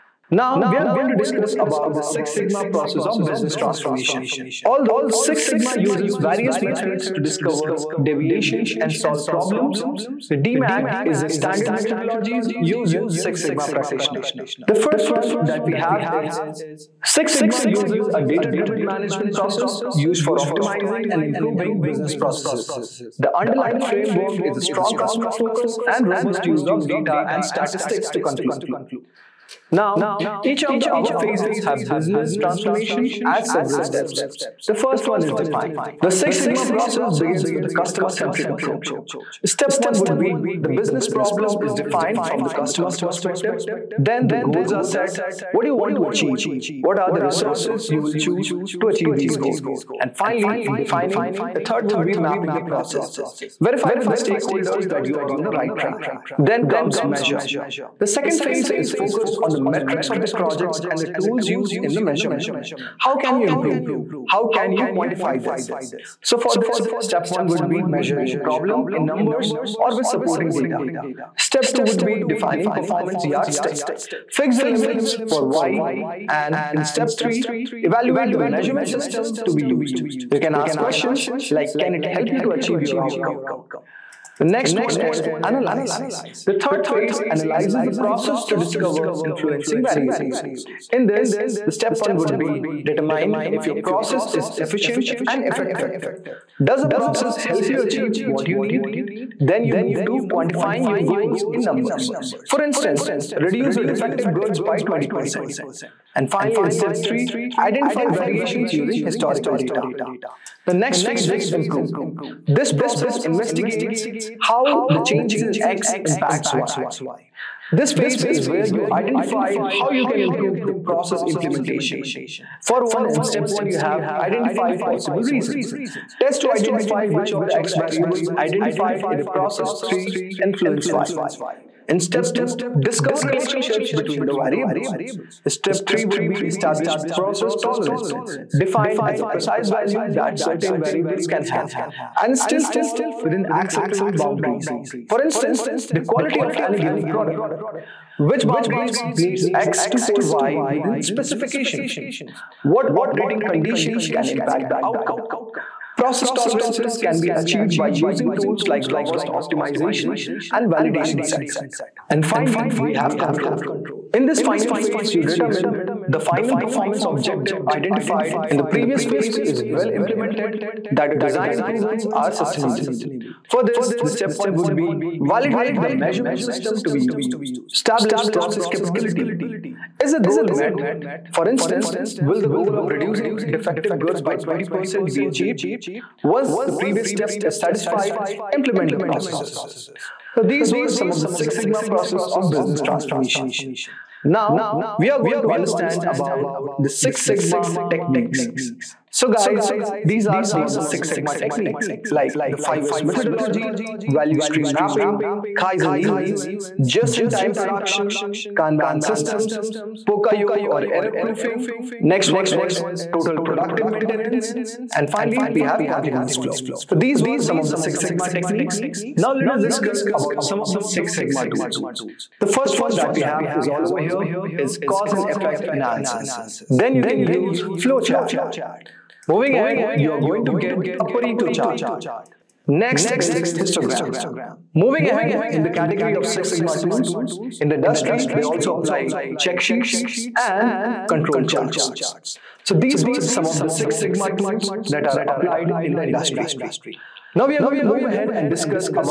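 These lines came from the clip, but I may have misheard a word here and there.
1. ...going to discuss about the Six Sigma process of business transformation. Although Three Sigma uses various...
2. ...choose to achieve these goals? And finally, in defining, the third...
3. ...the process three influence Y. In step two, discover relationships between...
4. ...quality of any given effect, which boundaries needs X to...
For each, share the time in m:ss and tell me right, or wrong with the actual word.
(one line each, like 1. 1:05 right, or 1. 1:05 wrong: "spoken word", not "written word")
1. 0:00 wrong: "Six", not "Three"
2. 0:48 right
3. 2:09 right
4. 2:26 wrong: "product", not "effect".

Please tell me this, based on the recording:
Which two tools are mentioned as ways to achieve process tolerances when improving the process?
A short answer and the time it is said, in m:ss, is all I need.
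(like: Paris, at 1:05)
robust optimization and validation set, at 2:38.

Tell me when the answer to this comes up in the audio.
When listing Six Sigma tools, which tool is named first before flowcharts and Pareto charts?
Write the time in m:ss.
3:44.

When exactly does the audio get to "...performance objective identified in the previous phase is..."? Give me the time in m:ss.
2:46.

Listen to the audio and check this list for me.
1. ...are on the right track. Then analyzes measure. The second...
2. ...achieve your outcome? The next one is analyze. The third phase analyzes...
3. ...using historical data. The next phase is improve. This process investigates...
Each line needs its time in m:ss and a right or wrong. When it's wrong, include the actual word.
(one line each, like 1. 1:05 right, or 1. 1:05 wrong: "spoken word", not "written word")
1. 0:55 wrong: "comes", not "analyzes"
2. 1:22 right
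3. 1:48 right.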